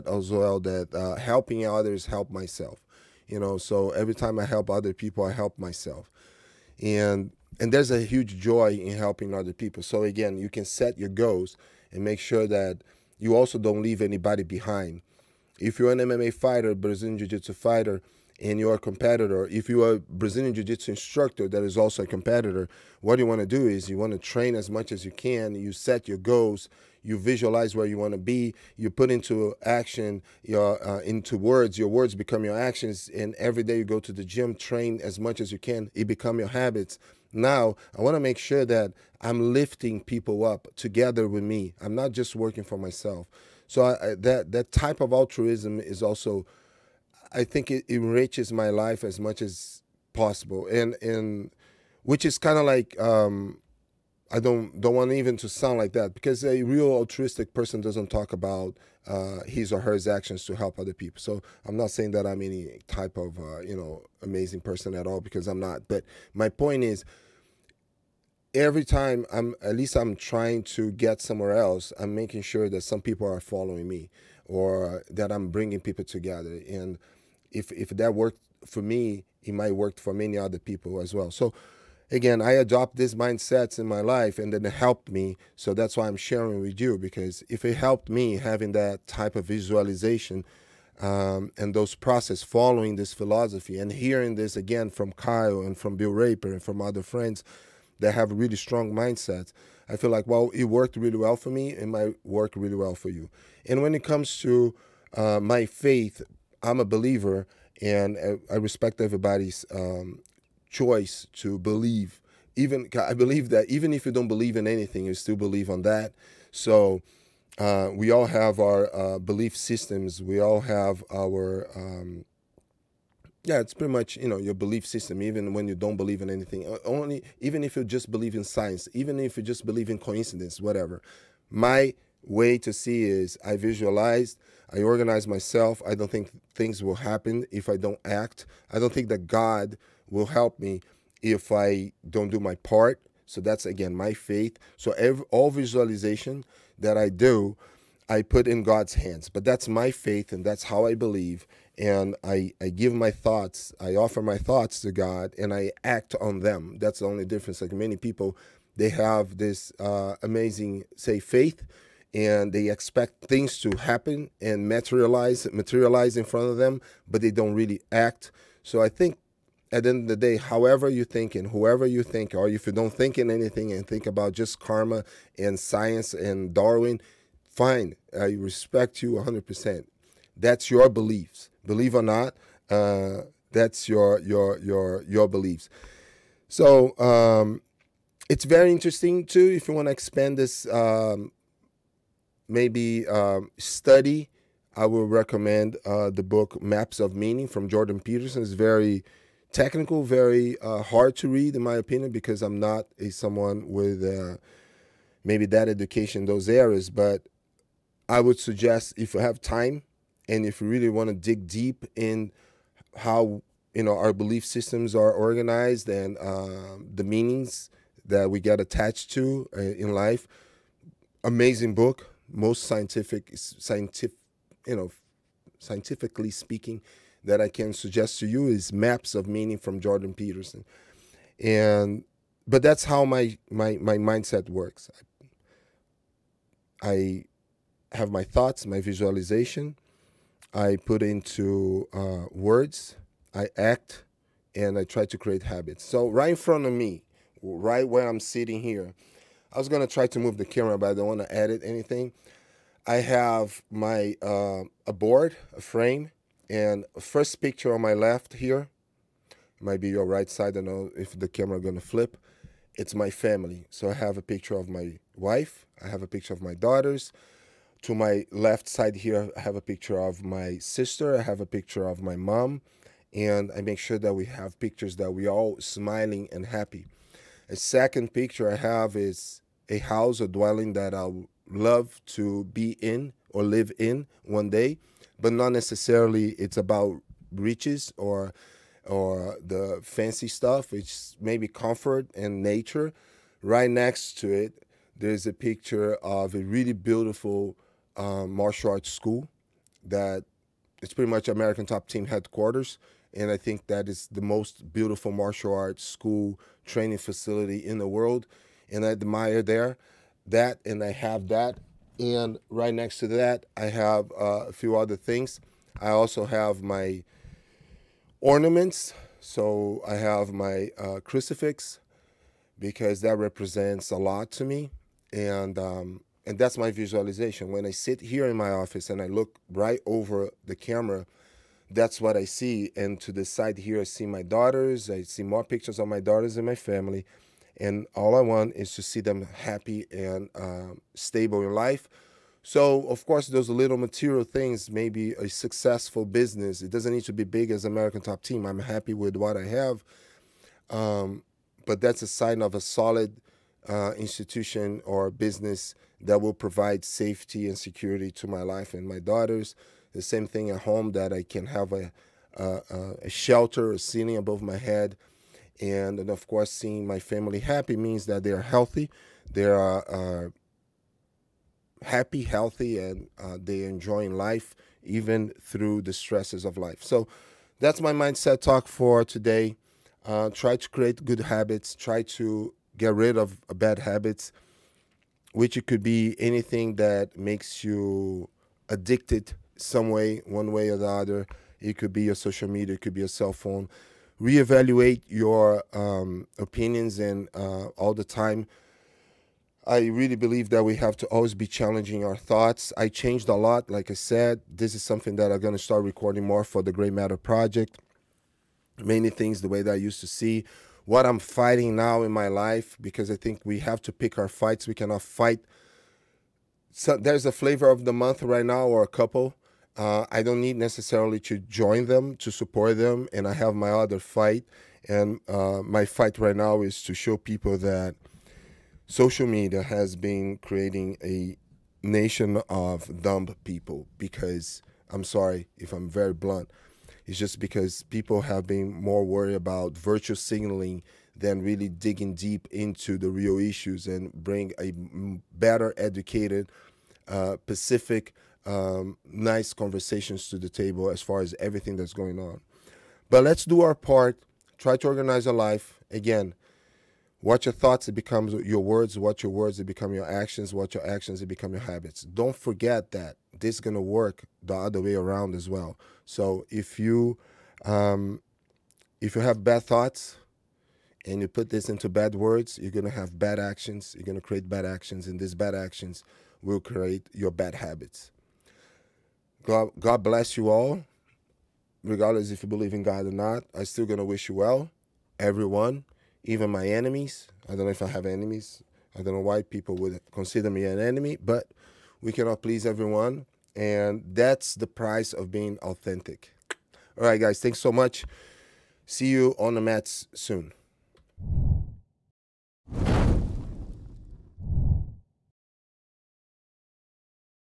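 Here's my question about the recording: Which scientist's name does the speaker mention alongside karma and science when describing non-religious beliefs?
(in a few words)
Darwin.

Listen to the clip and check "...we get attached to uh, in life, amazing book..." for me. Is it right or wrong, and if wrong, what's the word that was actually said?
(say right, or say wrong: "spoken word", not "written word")
right.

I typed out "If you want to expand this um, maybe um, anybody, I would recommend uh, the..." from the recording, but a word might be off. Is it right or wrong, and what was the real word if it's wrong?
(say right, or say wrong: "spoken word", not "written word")
wrong: "study", not "anybody".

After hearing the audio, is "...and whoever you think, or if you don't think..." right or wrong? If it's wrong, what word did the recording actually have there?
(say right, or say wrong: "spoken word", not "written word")
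right.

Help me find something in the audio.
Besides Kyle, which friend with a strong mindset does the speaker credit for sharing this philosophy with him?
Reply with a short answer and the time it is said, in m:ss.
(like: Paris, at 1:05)
Bill Raper, at 1:35.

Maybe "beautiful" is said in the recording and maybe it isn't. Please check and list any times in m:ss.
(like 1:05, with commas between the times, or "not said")
4:56, 5:04.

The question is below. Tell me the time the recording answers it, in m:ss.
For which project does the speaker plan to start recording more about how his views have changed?
6:46.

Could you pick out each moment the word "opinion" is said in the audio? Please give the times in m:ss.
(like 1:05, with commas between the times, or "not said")
3:21, 6:36.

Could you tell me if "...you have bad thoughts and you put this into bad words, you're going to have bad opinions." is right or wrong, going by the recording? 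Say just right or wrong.
wrong.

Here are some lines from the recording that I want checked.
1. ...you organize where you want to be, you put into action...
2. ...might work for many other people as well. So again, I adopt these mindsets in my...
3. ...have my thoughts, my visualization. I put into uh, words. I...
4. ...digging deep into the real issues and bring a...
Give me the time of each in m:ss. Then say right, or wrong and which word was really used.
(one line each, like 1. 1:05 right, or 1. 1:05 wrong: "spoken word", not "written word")
1. 0:27 wrong: "visualize", not "organize"
2. 1:19 right
3. 3:57 right
4. 7:21 right.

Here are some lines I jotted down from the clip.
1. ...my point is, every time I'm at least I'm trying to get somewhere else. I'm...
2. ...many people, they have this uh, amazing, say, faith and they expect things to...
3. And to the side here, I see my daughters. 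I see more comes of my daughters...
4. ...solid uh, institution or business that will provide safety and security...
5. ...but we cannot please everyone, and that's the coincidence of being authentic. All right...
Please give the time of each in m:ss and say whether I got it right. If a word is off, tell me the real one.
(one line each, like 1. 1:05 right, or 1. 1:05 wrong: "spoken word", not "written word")
1. 1:06 right
2. 2:37 right
3. 5:32 wrong: "pictures", not "comes"
4. 5:52 right
5. 8:11 wrong: "price", not "coincidence".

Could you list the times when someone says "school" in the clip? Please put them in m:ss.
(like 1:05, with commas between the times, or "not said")
4:58, 5:05.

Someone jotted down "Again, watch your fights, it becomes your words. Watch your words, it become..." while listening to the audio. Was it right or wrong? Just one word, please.
wrong.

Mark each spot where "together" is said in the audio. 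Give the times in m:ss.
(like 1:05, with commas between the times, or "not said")
0:40, 1:16.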